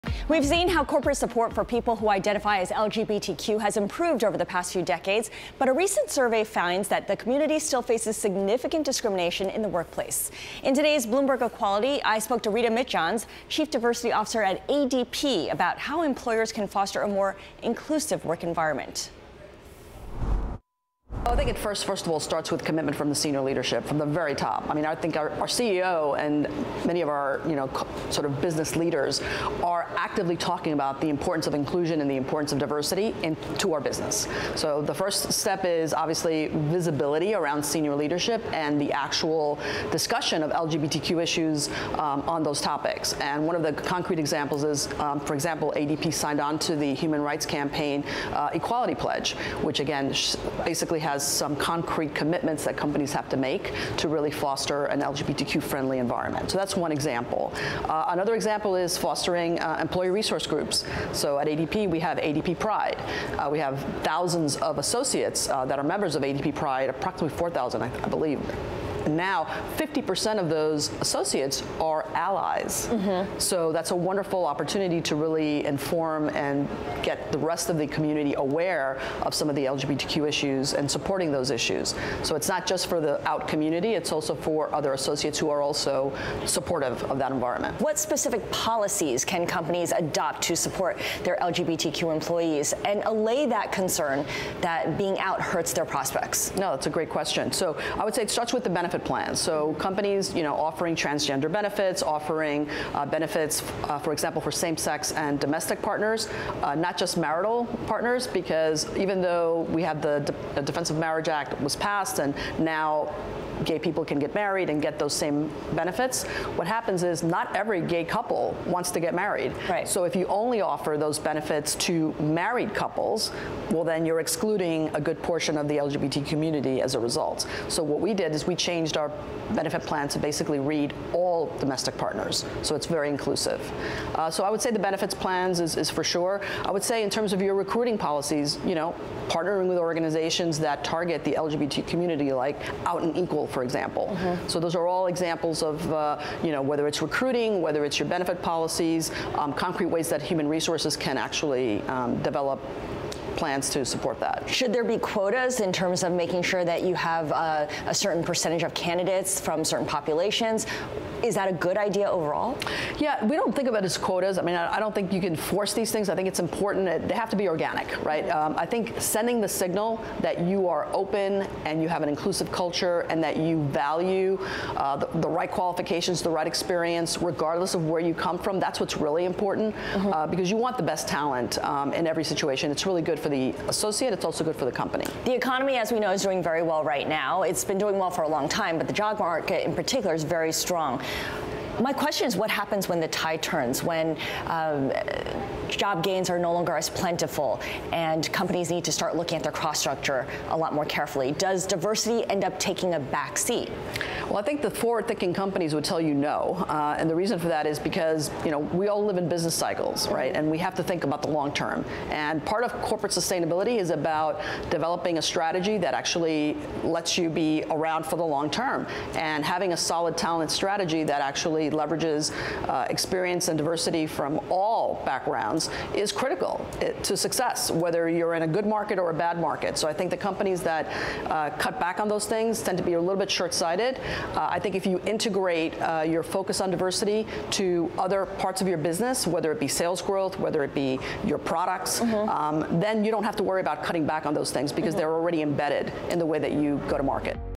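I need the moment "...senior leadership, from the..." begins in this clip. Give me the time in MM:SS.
00:23.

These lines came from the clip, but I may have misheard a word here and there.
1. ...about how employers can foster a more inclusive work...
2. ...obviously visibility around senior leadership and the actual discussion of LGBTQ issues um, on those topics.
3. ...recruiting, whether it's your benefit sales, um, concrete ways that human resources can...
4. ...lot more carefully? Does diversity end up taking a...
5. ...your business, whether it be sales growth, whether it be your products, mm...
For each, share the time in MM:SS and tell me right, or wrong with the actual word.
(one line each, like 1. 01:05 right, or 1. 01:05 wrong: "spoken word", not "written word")
1. 00:15 right
2. 00:35 right
3. 02:27 wrong: "policies", not "sales"
4. 03:20 right
5. 03:58 right.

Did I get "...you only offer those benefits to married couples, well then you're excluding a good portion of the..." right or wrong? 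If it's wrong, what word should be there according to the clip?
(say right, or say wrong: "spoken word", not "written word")
right.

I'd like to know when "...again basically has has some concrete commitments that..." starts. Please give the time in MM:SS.
00:49.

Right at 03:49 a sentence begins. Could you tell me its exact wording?
So I think the companies that uh, cut back on those things tend to be a little bit short-sighted.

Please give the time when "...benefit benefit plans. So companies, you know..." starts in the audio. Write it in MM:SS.
01:38.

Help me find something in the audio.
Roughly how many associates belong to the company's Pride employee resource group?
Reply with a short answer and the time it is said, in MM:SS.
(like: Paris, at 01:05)
4,000, at 01:07.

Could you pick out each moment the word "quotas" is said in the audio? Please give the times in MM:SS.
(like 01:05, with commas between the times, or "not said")
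02:34, 02:43.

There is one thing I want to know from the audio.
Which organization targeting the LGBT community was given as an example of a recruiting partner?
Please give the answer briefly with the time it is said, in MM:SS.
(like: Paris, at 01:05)
Out and Equal, at 02:22.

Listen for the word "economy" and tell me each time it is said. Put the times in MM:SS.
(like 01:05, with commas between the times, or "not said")
03:05.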